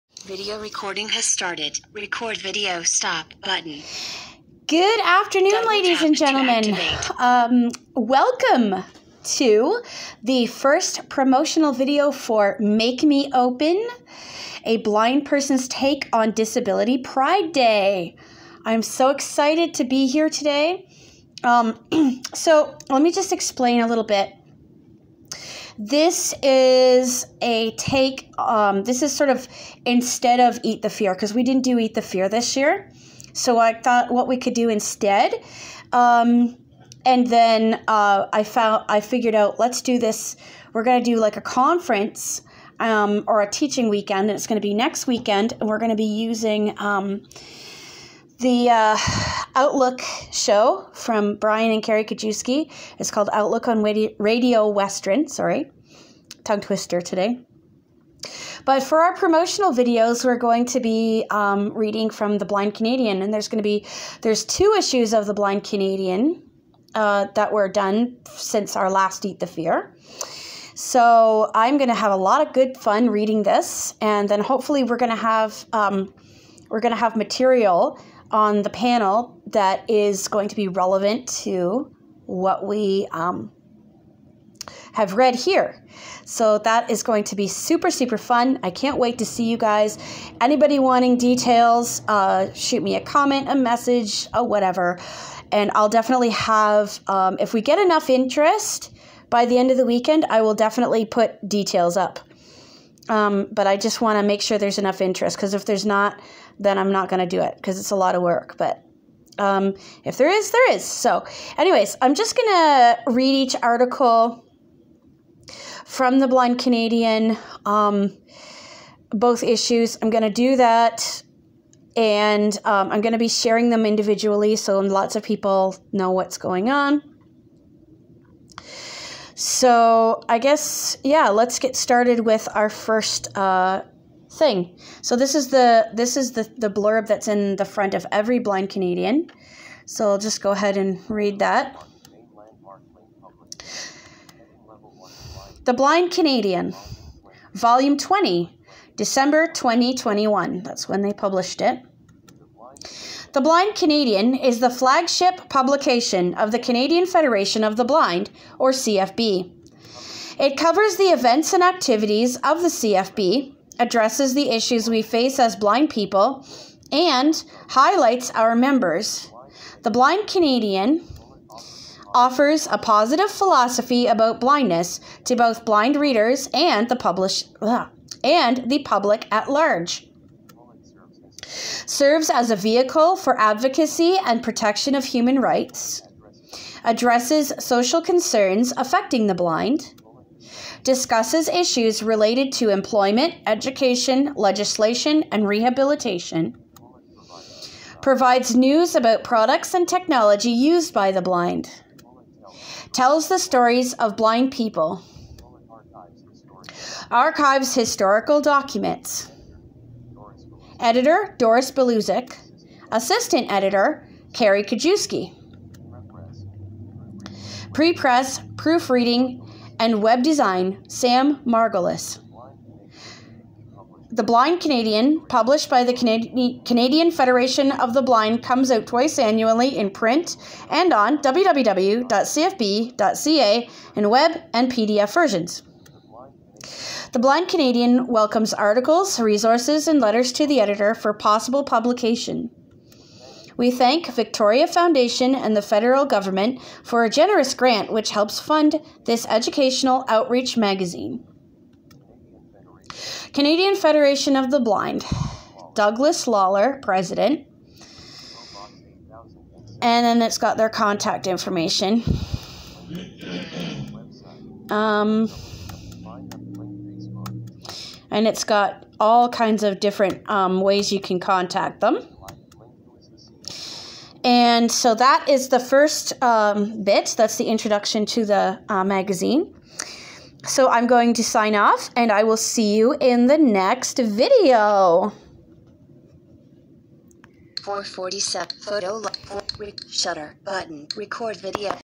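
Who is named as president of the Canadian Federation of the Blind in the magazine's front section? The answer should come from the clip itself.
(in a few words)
Douglas Lawler.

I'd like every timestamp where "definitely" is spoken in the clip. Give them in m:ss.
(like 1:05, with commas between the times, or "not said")
1:35, 1:40.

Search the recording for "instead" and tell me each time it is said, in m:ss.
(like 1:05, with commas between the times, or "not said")
0:29, 0:34.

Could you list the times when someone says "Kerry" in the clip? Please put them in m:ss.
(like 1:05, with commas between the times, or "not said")
0:51, 3:34.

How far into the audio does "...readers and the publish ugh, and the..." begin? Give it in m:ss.
2:55.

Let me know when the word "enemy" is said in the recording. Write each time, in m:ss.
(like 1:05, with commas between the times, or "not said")
not said.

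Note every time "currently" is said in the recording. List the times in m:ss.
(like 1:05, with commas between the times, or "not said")
not said.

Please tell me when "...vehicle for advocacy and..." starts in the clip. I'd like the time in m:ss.
3:02.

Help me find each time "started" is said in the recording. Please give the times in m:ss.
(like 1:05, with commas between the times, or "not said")
0:01, 2:11.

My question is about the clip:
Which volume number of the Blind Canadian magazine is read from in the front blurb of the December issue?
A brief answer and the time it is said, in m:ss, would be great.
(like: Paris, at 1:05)
20, at 2:27.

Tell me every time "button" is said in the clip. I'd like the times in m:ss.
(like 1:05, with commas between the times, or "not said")
0:03, 4:50.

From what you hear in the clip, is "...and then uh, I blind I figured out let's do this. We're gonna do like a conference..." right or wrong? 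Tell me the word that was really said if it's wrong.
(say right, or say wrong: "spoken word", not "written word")
wrong: "found", not "blind".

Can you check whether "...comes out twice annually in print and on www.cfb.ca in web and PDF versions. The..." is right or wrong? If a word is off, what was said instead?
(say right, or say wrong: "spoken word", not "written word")
right.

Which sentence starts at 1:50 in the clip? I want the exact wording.
So, anyways, I'm just going to read each article from the Blind Canadian, um, both issues.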